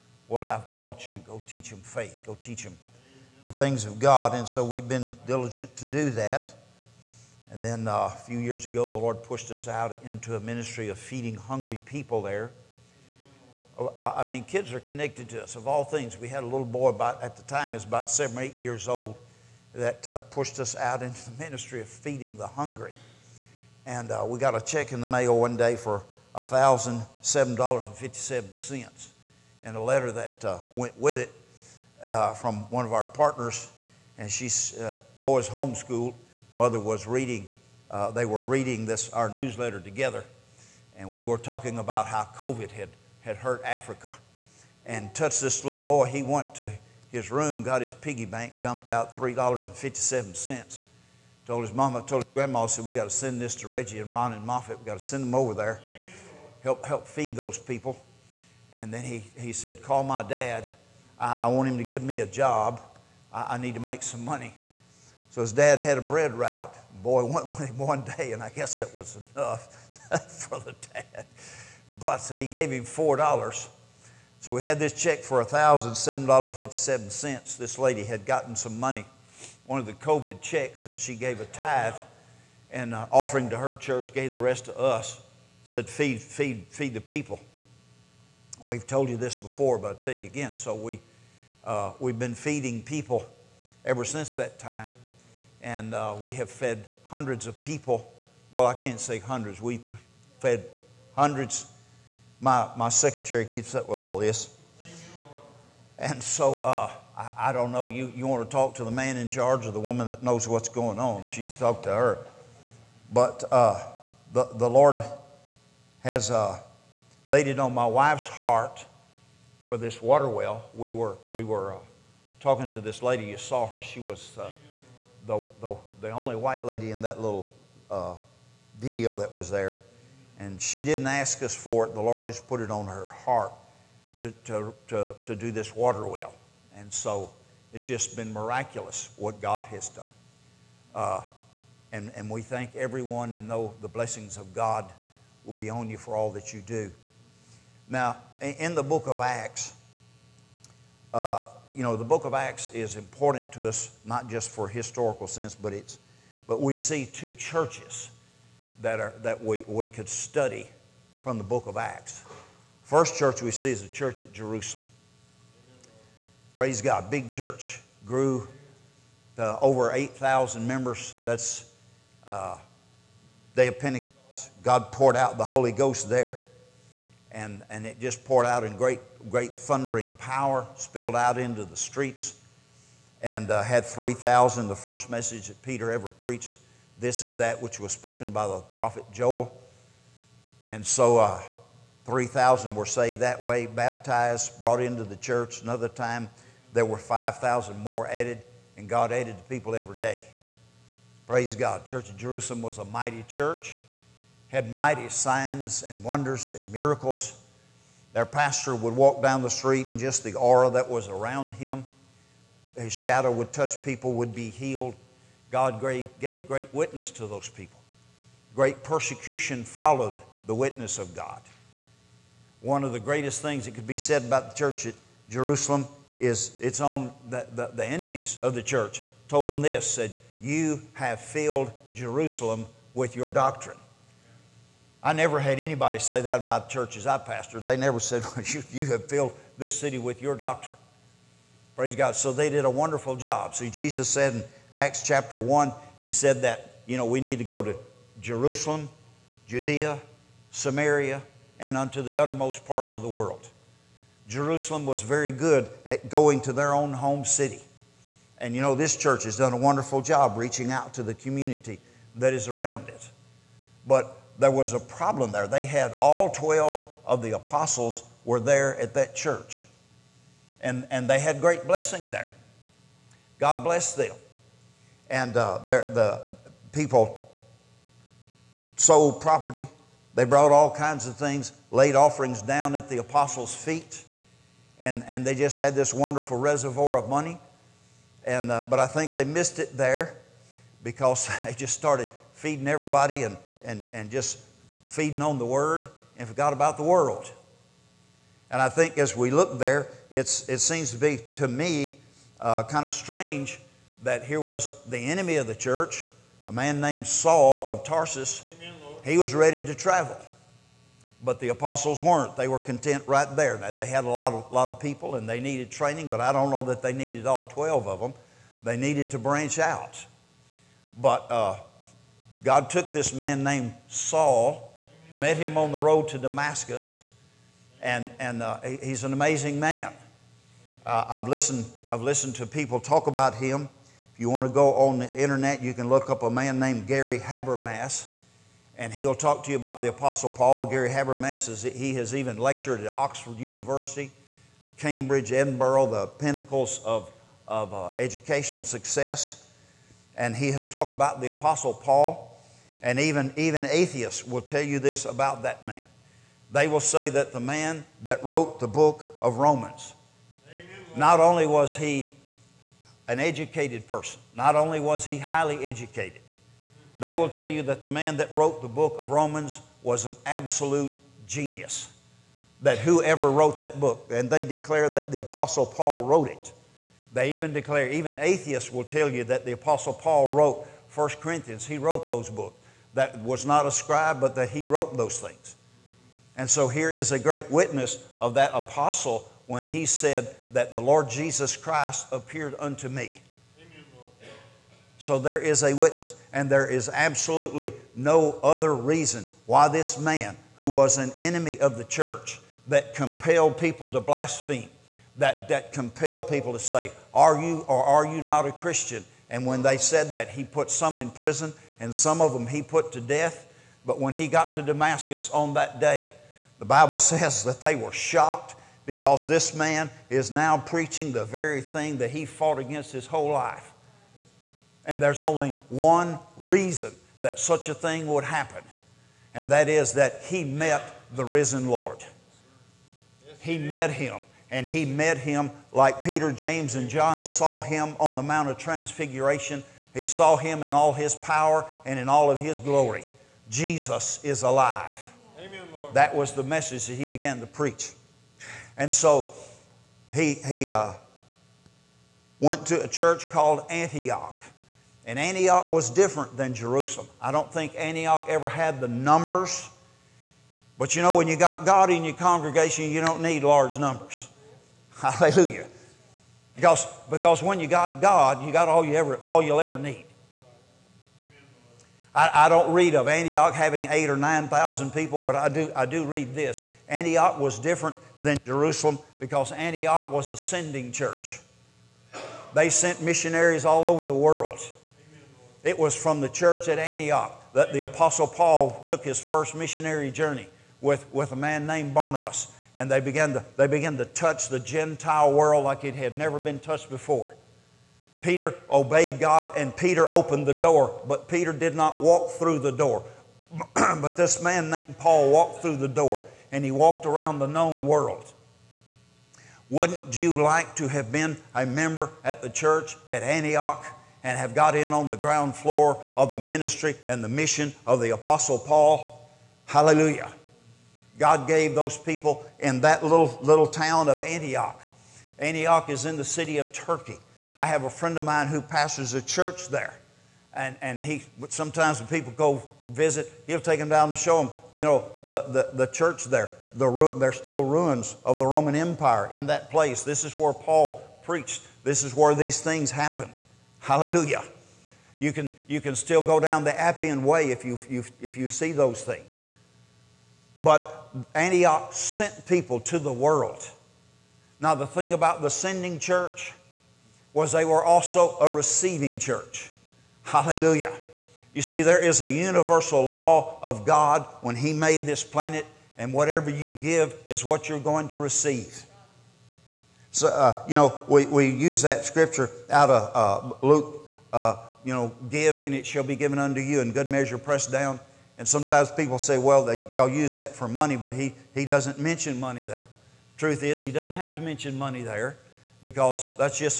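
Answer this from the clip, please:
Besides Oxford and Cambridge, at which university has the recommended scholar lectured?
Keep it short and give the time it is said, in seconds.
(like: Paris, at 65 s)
Edinburgh, at 345 s.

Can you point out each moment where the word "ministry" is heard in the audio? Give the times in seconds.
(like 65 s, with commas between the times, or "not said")
10 s, 21 s, 516 s.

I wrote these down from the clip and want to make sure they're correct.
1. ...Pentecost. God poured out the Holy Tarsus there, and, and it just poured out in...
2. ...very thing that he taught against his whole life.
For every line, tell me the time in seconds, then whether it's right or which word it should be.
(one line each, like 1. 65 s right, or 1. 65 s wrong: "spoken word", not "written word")
1. 173 s wrong: "Ghost", not "Tarsus"
2. 421 s wrong: "fought", not "taught".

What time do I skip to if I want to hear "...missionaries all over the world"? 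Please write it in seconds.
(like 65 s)
483 s.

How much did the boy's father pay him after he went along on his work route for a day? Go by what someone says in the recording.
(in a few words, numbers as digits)
$4.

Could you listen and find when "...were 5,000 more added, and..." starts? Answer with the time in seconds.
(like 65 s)
196 s.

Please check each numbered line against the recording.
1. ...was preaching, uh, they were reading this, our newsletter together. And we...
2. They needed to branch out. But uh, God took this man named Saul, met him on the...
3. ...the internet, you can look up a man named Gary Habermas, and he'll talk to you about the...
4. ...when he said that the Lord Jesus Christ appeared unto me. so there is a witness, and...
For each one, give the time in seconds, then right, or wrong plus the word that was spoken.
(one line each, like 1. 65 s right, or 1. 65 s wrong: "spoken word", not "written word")
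1. 36 s wrong: "reading", not "preaching"
2. 318 s right
3. 334 s right
4. 389 s right.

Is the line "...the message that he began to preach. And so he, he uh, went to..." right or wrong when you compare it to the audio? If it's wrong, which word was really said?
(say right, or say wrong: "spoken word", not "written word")
right.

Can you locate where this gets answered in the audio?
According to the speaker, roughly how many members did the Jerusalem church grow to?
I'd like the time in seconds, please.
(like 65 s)
169 s.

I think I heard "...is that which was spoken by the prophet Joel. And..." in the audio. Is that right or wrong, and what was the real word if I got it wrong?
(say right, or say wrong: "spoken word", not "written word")
right.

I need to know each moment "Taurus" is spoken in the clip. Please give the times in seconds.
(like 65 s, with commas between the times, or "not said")
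not said.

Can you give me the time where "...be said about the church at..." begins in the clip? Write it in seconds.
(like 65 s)
223 s.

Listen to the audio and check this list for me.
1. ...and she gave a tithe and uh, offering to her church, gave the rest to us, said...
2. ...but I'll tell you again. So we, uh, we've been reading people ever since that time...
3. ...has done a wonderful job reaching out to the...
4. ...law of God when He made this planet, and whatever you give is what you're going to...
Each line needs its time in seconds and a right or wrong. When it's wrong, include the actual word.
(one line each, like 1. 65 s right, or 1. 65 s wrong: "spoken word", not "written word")
1. 80 s right
2. 89 s wrong: "feeding", not "reading"
3. 259 s right
4. 563 s right.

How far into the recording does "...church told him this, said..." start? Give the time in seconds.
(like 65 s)
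228 s.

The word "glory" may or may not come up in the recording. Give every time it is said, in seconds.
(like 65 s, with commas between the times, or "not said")
442 s.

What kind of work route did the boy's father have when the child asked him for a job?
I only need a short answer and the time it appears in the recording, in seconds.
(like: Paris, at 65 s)
bread route, at 66 s.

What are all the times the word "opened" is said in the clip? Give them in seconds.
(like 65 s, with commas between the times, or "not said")
500 s.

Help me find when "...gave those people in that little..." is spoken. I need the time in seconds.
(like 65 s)
521 s.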